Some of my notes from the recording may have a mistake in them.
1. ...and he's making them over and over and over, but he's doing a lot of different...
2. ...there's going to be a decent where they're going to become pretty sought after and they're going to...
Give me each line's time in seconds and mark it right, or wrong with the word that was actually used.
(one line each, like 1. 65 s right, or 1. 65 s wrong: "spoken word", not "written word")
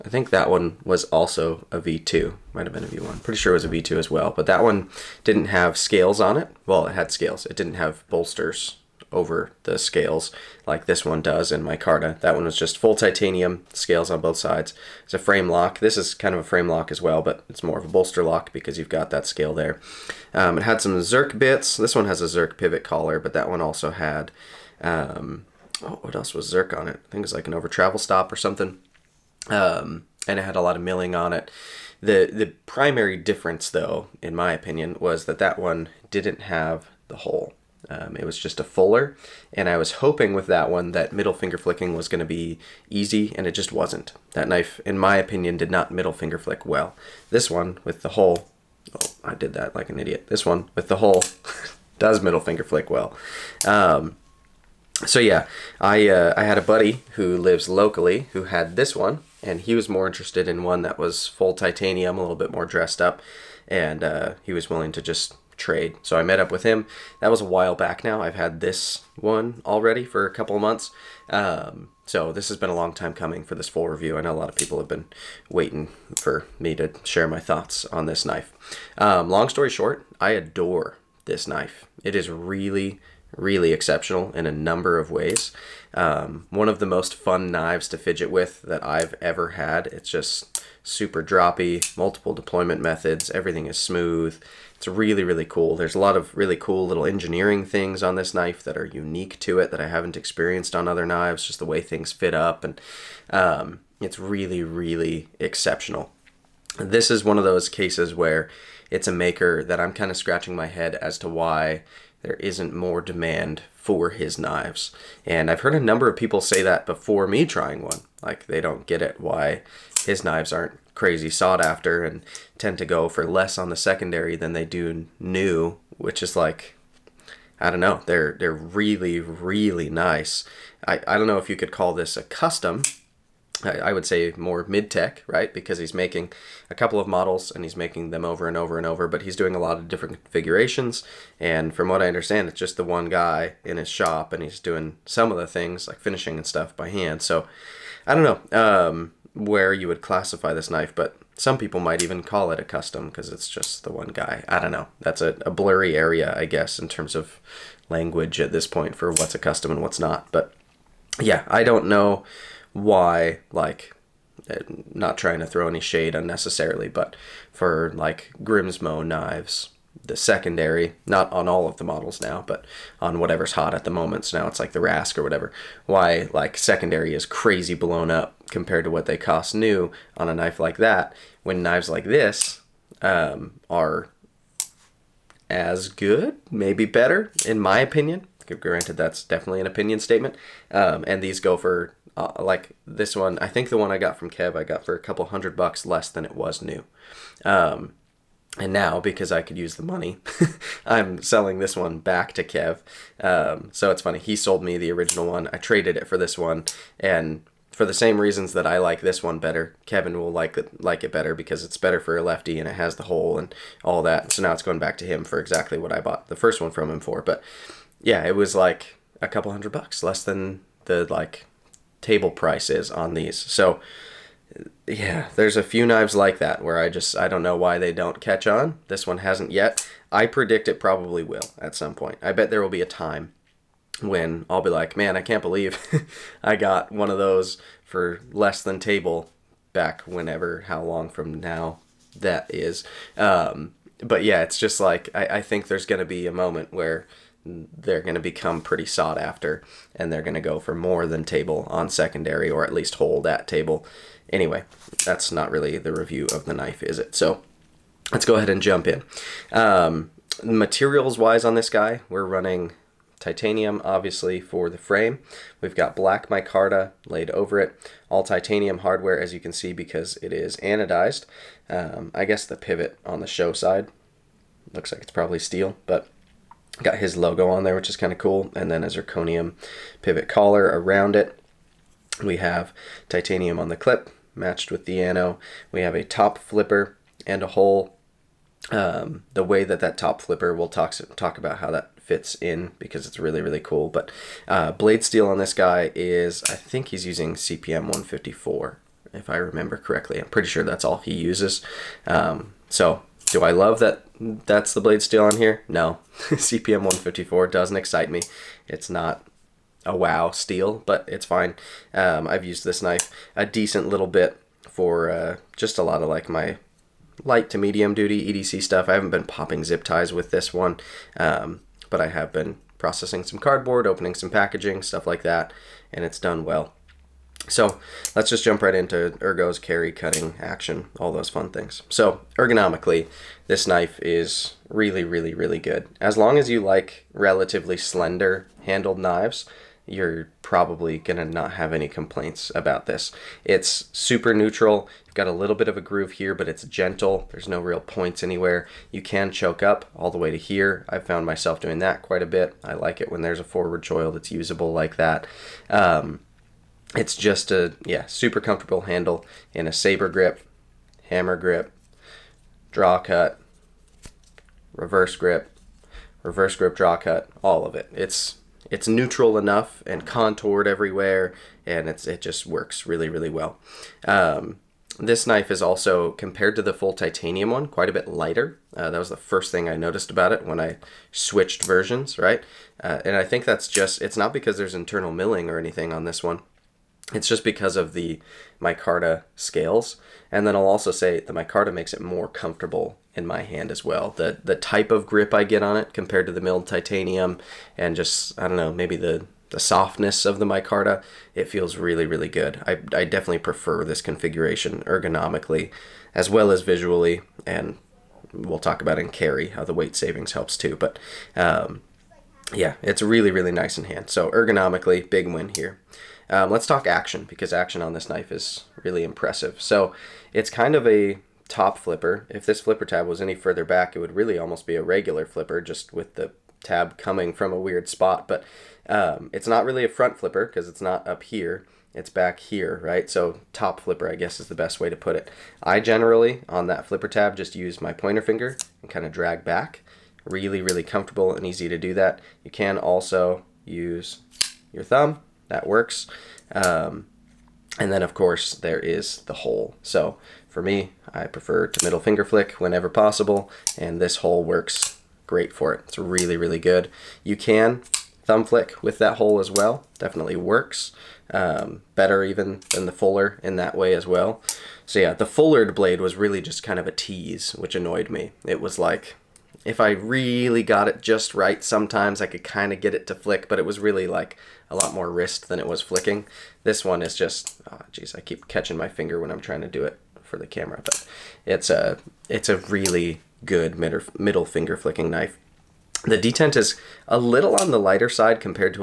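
1. 137 s right
2. 245 s wrong: "moment", not "decent".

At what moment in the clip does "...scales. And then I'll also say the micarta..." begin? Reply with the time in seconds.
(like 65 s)
389 s.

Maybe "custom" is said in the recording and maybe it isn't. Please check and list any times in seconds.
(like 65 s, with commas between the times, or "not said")
132 s, 152 s, 159 s.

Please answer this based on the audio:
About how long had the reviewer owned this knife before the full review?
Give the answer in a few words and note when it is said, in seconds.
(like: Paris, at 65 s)
A couple of months, at 70 s.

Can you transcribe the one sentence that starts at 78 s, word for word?
Um, long story short, I adore this knife.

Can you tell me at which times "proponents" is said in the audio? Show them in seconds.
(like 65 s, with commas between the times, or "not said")
not said.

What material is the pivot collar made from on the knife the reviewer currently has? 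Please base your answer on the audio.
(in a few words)
Zirconium.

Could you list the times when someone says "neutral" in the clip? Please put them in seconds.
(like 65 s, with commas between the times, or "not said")
344 s, 368 s.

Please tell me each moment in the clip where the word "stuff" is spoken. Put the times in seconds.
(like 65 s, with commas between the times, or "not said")
146 s, 318 s, 324 s.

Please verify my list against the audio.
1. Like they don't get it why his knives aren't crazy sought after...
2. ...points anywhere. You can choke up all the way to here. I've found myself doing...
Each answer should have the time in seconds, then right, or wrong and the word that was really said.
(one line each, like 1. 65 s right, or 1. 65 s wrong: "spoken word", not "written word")
1. 118 s right
2. 347 s right.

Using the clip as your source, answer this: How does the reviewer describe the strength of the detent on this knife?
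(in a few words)
Lighter side.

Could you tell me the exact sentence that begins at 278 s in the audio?
And then a zirconium pivot collar around it.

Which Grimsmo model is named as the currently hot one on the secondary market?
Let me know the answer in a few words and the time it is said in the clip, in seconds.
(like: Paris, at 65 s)
Rask, at 174 s.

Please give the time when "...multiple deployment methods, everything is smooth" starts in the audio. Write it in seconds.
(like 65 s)
91 s.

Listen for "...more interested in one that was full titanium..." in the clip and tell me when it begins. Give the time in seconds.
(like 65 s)
59 s.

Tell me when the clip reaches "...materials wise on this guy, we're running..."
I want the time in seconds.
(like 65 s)
260 s.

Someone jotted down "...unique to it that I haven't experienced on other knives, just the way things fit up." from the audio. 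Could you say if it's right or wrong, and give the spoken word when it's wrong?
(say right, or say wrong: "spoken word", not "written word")
right.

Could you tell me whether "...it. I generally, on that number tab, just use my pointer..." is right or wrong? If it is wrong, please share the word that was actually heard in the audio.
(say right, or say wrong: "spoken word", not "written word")
wrong: "flipper", not "number".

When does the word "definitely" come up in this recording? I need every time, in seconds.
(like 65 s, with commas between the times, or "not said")
189 s, 403 s, 459 s.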